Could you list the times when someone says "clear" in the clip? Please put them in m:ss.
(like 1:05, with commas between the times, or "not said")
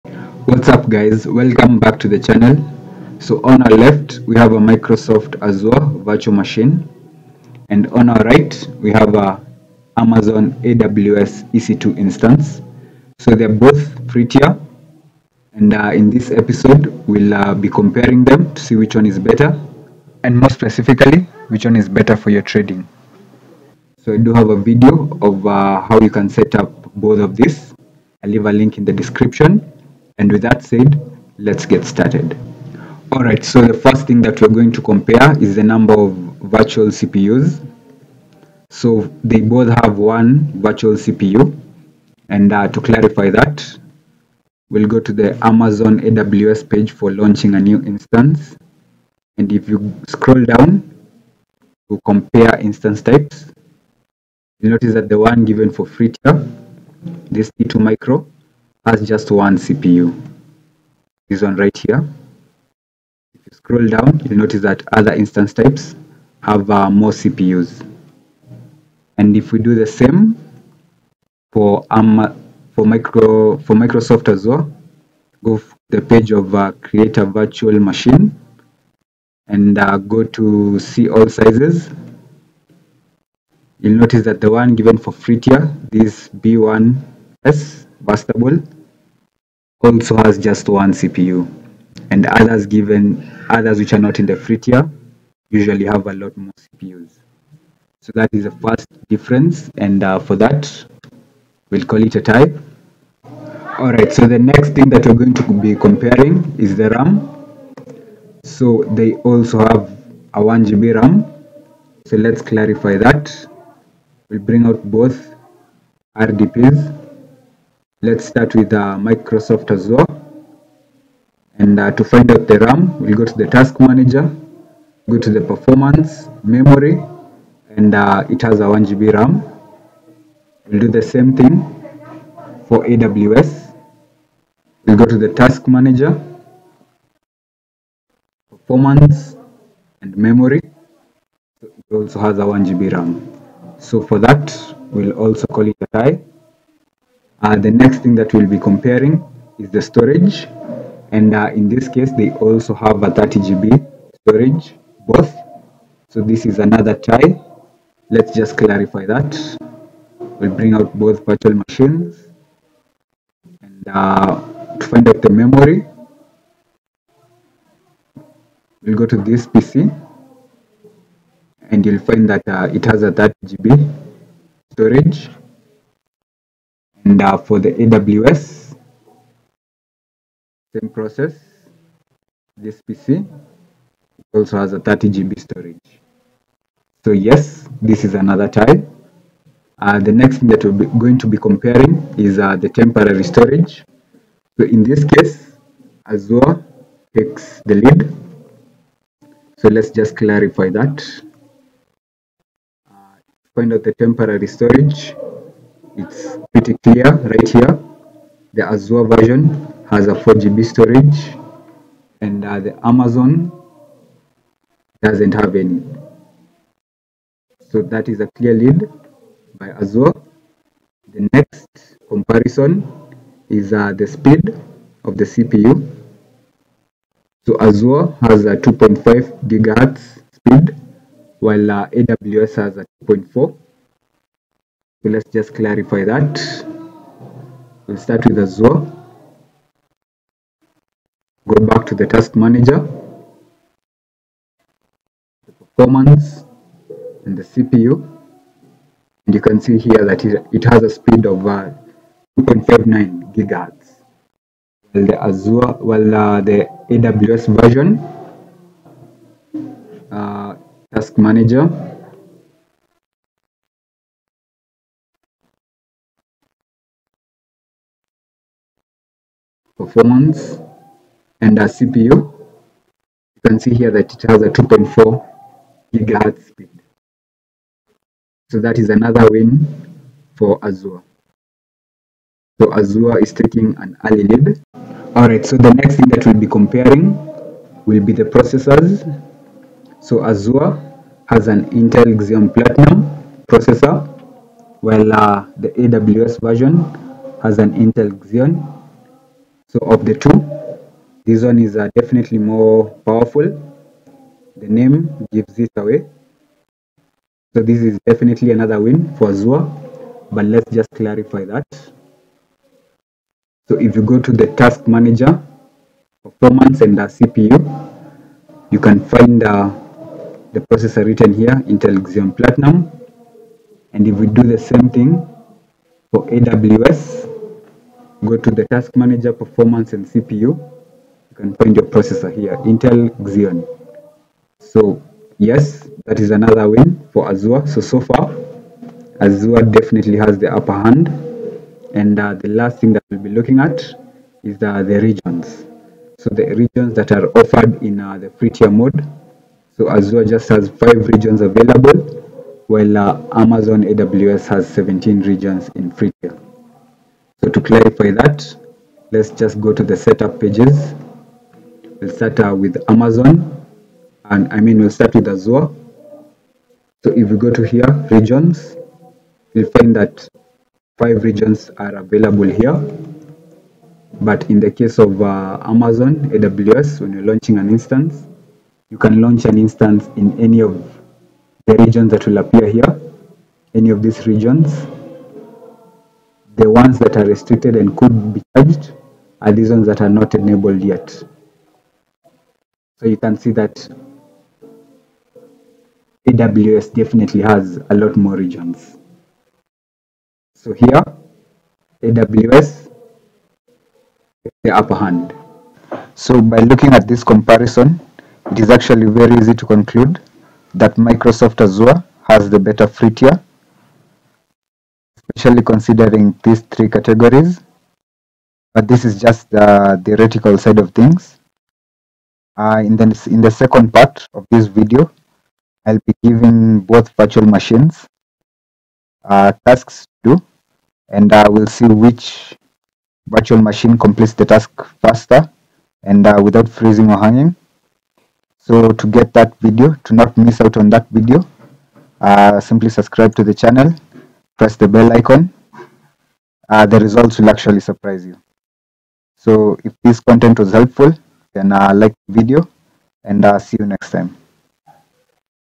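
3:26, 3:38.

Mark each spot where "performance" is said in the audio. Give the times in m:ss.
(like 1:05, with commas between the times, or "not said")
2:05, 2:18, 4:05, 4:29, 5:16, 5:29.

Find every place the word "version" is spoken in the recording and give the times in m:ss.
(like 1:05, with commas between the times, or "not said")
3:29, 4:17, 4:56.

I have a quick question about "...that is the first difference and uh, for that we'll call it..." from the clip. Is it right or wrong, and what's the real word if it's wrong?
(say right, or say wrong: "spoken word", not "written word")
right.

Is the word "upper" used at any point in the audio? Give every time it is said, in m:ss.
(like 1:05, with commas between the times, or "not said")
5:40, 6:44.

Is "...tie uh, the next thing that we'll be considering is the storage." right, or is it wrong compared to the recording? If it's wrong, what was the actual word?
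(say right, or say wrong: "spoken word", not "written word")
wrong: "comparing", not "considering".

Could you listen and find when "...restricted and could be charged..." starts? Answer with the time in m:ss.
6:27.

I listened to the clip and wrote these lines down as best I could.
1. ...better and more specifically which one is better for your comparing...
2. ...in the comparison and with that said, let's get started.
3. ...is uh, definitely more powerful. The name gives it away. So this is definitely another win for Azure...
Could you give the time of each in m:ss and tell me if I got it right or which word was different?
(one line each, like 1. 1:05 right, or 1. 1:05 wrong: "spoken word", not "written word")
1. 0:19 wrong: "trading", not "comparing"
2. 0:28 wrong: "description", not "comparison"
3. 5:01 right.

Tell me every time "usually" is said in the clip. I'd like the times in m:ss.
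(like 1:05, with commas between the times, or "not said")
1:35.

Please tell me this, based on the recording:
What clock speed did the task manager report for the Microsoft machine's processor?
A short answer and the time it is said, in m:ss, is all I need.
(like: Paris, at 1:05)
2.59 GHz, at 4:12.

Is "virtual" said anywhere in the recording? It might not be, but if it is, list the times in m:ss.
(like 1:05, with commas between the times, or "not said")
0:06, 0:36, 0:40, 1:17, 2:41, 7:07, 7:13.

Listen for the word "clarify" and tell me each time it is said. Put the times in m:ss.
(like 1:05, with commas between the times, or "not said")
0:42, 1:52, 2:38, 3:20, 3:55, 5:10, 5:57.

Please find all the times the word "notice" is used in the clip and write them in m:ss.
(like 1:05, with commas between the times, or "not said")
0:54, 1:04, 1:23.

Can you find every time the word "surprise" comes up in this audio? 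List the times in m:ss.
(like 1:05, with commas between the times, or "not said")
7:27.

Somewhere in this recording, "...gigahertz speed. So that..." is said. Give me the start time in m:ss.
4:35.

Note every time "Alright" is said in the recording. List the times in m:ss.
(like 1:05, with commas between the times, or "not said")
1:43, 4:45.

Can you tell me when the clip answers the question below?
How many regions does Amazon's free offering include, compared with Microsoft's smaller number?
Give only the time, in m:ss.
5:54.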